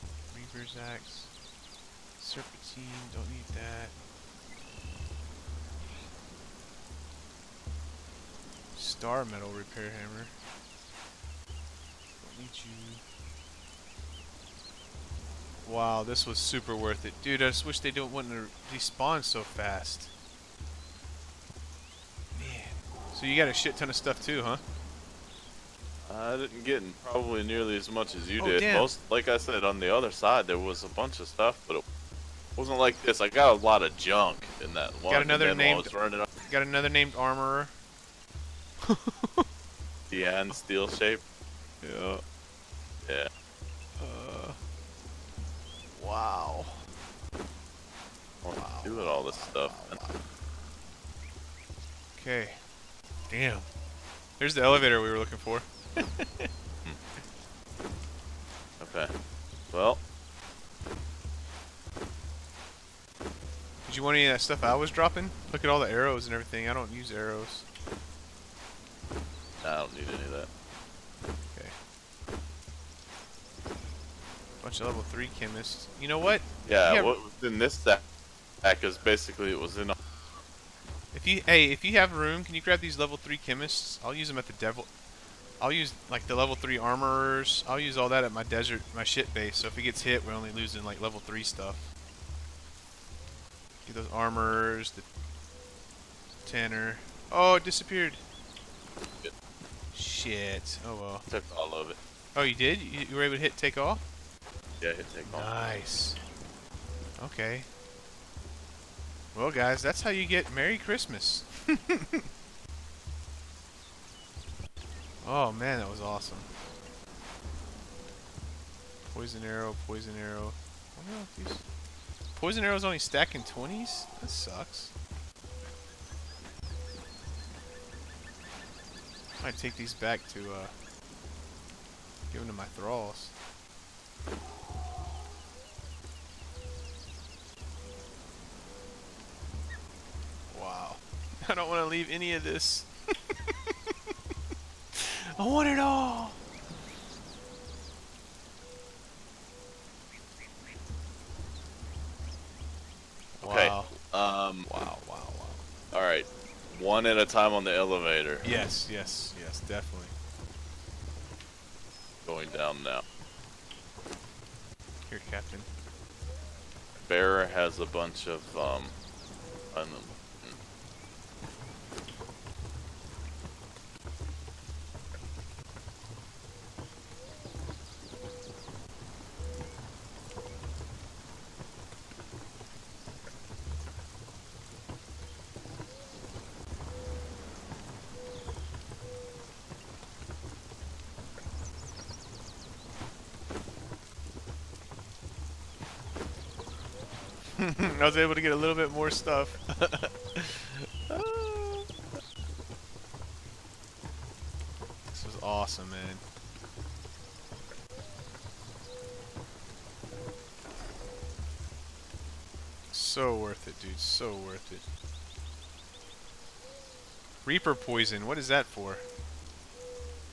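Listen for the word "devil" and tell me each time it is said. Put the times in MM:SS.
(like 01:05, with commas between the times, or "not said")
01:24.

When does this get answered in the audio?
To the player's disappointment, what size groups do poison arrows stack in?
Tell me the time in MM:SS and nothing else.
02:03.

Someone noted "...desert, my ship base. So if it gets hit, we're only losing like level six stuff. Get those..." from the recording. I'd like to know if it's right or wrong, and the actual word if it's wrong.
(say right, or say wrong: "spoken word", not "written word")
wrong: "three", not "six".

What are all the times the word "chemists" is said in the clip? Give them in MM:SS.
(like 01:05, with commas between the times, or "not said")
01:15, 01:23.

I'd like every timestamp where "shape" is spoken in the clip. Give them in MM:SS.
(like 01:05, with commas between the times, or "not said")
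00:40.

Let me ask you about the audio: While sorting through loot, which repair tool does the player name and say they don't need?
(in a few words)
Star metal repair hammer.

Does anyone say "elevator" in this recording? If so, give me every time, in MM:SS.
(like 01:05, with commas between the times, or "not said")
00:54, 02:37.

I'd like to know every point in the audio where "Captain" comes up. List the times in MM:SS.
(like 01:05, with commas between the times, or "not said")
02:45.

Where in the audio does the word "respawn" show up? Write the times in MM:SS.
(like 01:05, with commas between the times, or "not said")
00:18.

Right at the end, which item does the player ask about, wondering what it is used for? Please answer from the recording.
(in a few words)
Reaper poison.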